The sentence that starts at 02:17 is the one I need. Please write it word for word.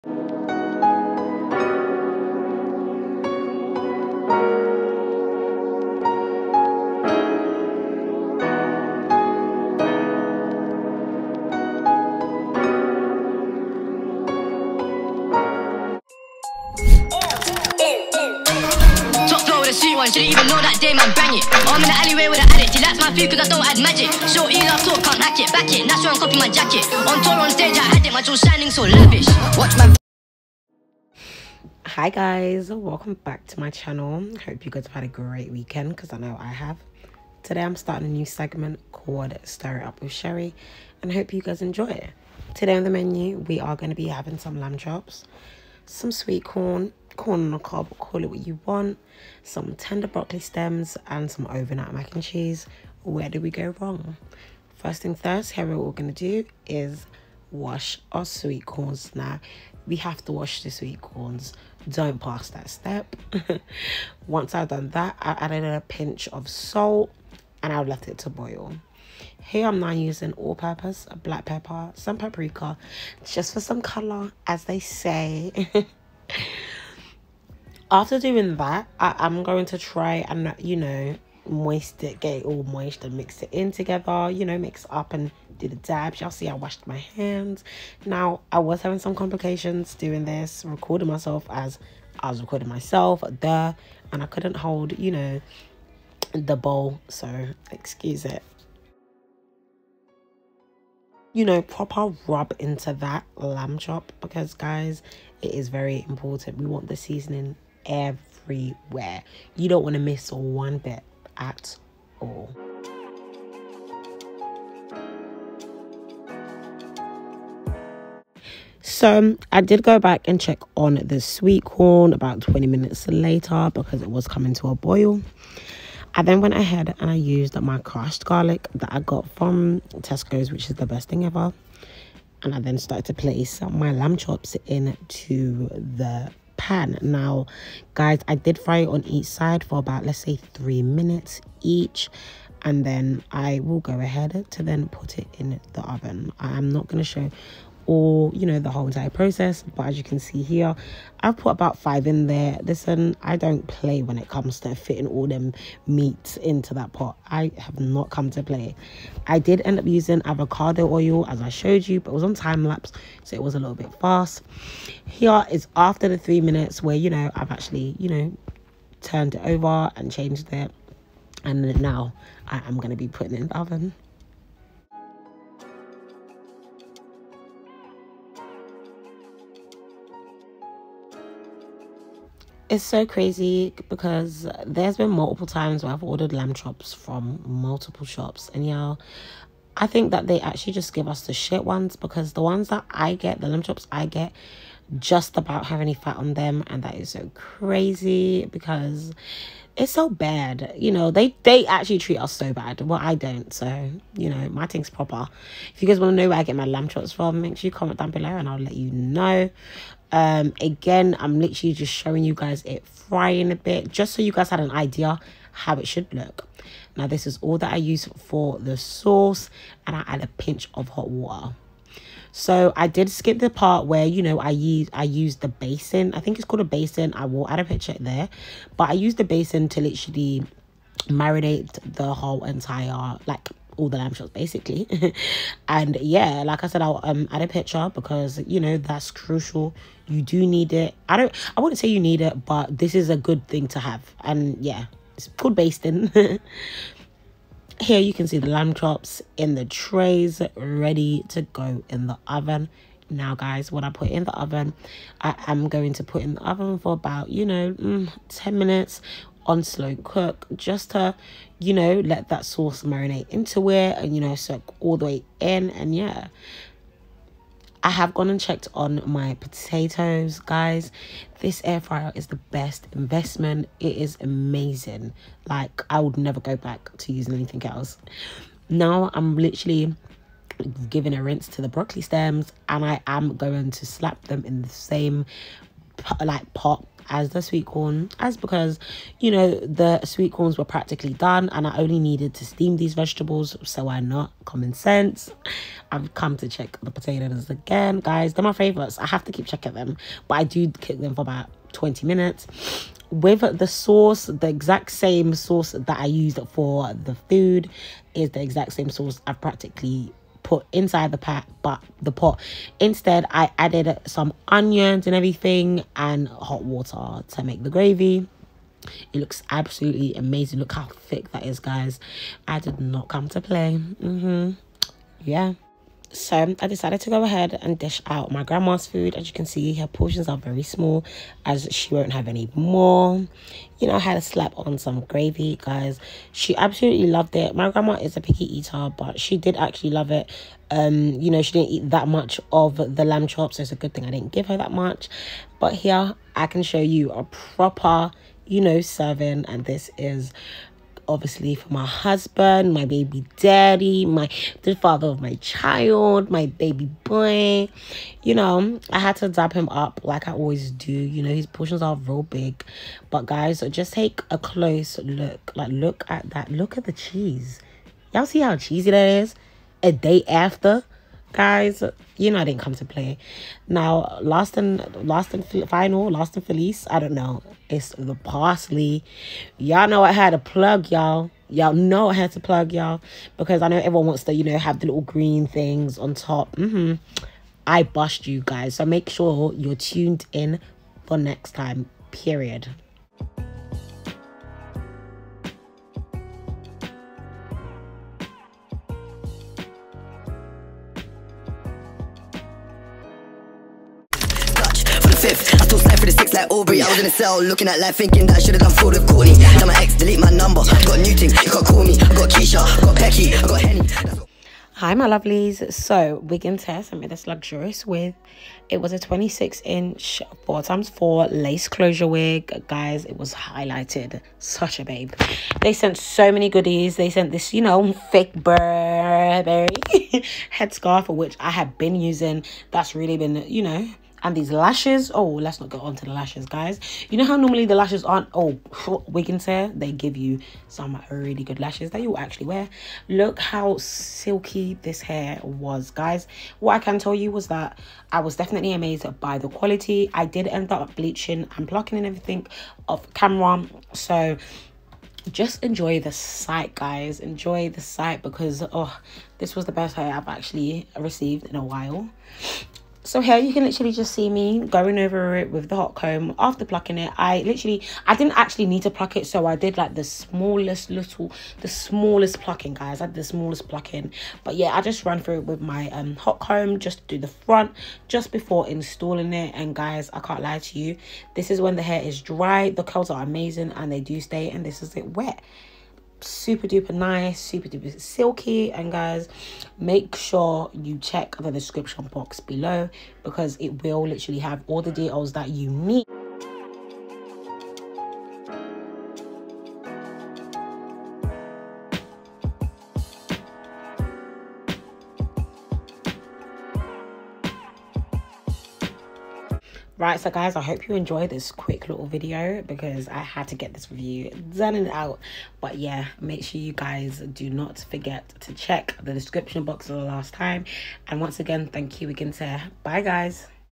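Now, guys, I did fry it on each side for about, let's say, three minutes each.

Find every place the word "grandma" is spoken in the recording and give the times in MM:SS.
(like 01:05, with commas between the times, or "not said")
05:28, 05:37.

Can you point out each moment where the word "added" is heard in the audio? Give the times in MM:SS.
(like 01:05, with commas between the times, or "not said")
01:05, 05:13.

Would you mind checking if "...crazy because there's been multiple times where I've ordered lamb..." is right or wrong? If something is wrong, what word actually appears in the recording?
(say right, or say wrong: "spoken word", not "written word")
right.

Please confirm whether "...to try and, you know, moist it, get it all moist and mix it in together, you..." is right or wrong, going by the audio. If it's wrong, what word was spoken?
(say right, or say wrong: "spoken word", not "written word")
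right.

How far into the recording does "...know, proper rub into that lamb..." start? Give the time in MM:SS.
01:41.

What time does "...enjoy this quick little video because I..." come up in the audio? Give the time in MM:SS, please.
08:30.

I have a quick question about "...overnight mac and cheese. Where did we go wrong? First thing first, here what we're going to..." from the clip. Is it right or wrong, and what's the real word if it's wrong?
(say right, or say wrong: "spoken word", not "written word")
right.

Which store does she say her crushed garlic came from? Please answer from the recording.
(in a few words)
Tesco's.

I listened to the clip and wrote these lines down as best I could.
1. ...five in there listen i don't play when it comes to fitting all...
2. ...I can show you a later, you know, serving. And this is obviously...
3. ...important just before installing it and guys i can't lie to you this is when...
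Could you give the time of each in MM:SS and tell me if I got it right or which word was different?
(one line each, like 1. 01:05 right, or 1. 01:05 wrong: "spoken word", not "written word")
1. 02:31 right
2. 05:46 wrong: "proper", not "later"
3. 07:57 wrong: "front", not "important".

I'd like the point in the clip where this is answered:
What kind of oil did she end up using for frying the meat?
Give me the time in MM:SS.
02:40.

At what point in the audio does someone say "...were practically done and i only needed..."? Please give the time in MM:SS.
04:50.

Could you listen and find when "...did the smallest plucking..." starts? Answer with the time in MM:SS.
07:53.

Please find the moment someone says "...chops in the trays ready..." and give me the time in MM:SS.
04:08.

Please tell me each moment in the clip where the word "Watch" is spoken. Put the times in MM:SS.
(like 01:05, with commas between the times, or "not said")
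00:29.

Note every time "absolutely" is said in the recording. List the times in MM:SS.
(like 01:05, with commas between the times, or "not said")
05:19, 05:36.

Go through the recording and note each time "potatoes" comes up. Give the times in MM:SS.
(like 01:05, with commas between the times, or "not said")
04:29, 04:56.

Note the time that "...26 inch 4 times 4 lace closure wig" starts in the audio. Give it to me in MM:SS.
06:58.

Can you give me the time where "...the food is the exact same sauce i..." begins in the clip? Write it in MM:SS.
05:06.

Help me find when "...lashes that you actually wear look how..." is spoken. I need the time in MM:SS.
07:21.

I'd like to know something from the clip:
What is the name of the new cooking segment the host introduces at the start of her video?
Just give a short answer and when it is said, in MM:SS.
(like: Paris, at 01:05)
Stir It Up with Sherry, at 00:39.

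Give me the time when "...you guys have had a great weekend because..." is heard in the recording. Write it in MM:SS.
00:34.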